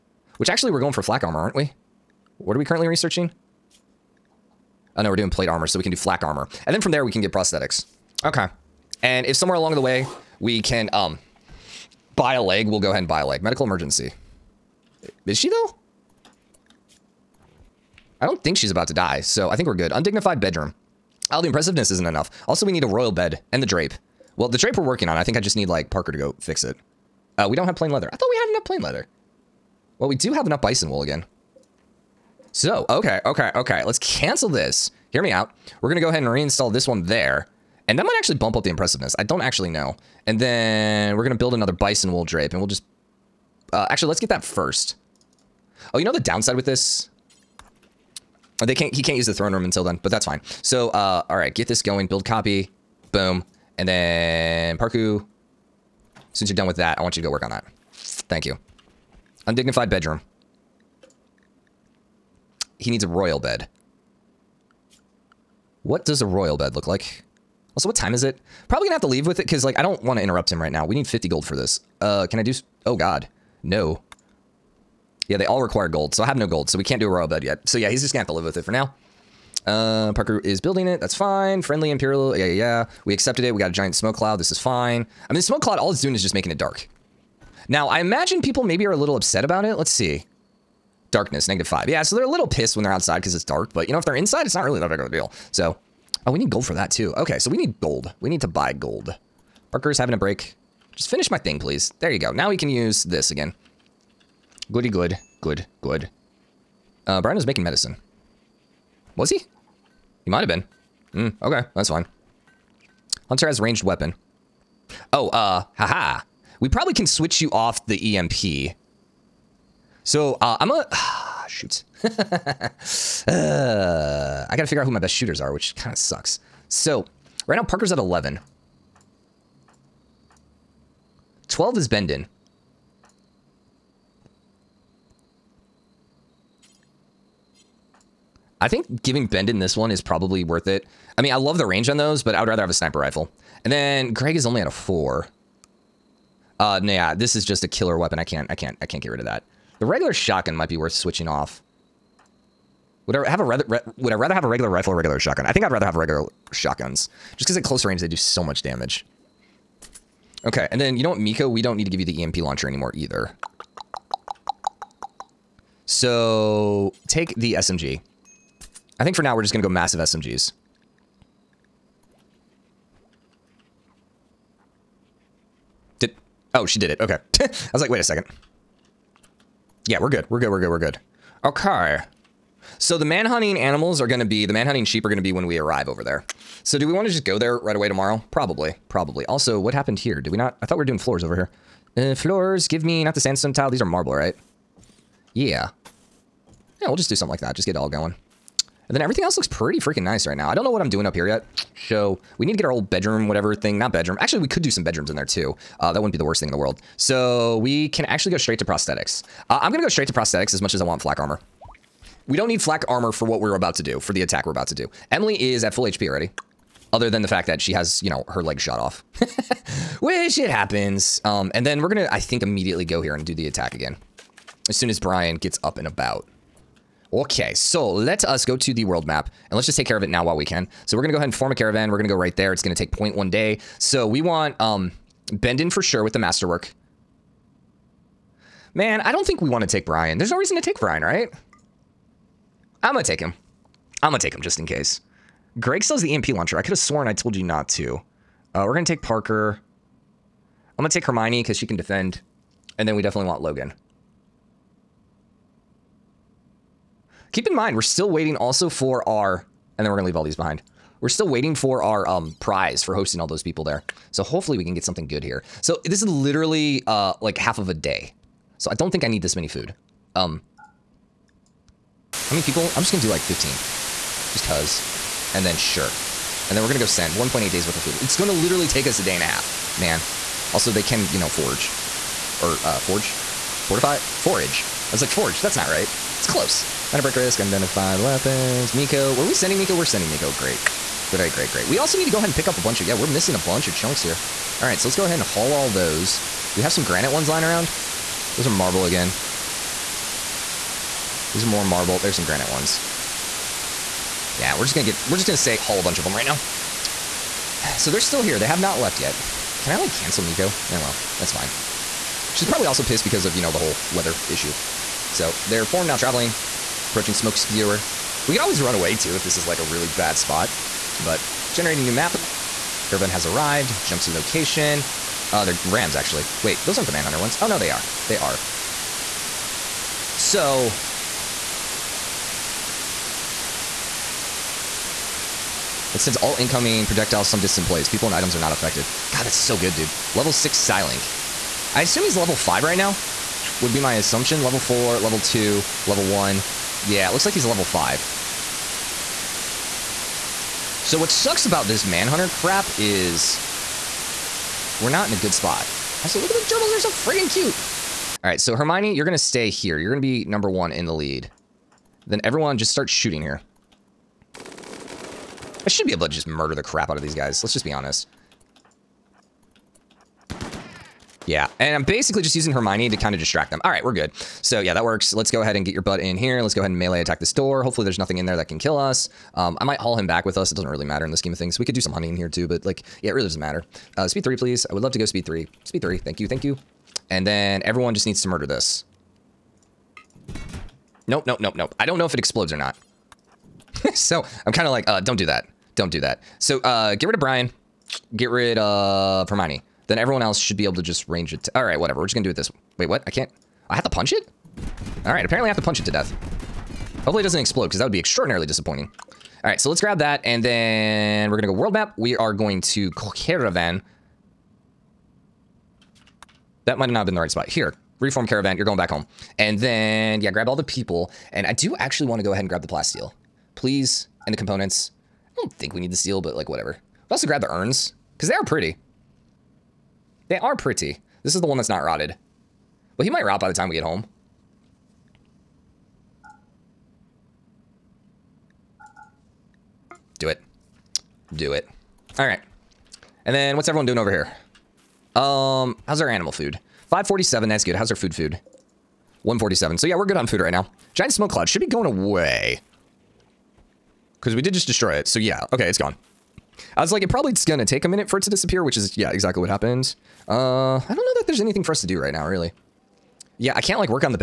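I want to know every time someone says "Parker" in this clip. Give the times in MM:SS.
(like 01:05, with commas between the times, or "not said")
00:25, 00:54, 01:20, 01:39, 02:07, 04:09.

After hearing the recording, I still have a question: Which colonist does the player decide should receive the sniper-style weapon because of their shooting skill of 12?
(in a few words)
Bendin.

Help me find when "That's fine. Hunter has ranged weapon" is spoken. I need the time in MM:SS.
01:51.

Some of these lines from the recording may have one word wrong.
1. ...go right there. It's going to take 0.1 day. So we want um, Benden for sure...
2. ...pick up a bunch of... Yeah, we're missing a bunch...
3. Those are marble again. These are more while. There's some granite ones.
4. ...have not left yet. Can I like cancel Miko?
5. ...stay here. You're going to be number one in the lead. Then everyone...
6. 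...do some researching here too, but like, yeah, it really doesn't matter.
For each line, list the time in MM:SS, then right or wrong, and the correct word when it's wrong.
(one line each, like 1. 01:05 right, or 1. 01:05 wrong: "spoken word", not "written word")
1. 03:52 right
2. 04:52 right
3. 04:58 wrong: "marble", not "while"
4. 05:08 right
5. 05:59 right
6. 06:21 wrong: "hunting", not "researching".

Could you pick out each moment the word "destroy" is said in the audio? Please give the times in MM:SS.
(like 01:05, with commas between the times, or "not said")
07:34.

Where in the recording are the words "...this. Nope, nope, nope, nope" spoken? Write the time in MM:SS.
06:28.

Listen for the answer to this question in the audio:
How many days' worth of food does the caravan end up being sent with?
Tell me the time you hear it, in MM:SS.
04:37.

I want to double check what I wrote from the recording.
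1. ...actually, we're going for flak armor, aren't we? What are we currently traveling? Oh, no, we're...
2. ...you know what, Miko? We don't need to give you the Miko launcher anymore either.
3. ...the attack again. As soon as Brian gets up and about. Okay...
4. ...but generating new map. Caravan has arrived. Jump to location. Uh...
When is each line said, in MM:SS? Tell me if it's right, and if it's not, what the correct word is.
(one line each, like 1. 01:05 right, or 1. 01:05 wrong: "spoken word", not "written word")
1. 00:00 wrong: "researching", not "traveling"
2. 02:40 wrong: "EMP", not "Miko"
3. 03:43 right
4. 05:20 right.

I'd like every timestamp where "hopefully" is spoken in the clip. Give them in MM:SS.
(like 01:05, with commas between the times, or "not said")
04:24, 06:17, 06:47.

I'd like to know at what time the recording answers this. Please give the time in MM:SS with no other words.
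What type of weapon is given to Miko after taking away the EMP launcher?
02:47.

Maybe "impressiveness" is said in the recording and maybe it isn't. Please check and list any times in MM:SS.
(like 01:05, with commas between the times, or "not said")
00:21, 00:38.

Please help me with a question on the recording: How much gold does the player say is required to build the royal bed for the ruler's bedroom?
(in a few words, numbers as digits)
50.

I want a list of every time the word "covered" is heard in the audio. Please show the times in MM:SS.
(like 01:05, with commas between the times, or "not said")
not said.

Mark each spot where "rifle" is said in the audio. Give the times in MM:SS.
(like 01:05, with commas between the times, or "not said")
02:22, 02:34.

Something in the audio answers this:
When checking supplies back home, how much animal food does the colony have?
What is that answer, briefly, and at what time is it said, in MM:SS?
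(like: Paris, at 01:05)
547, at 07:26.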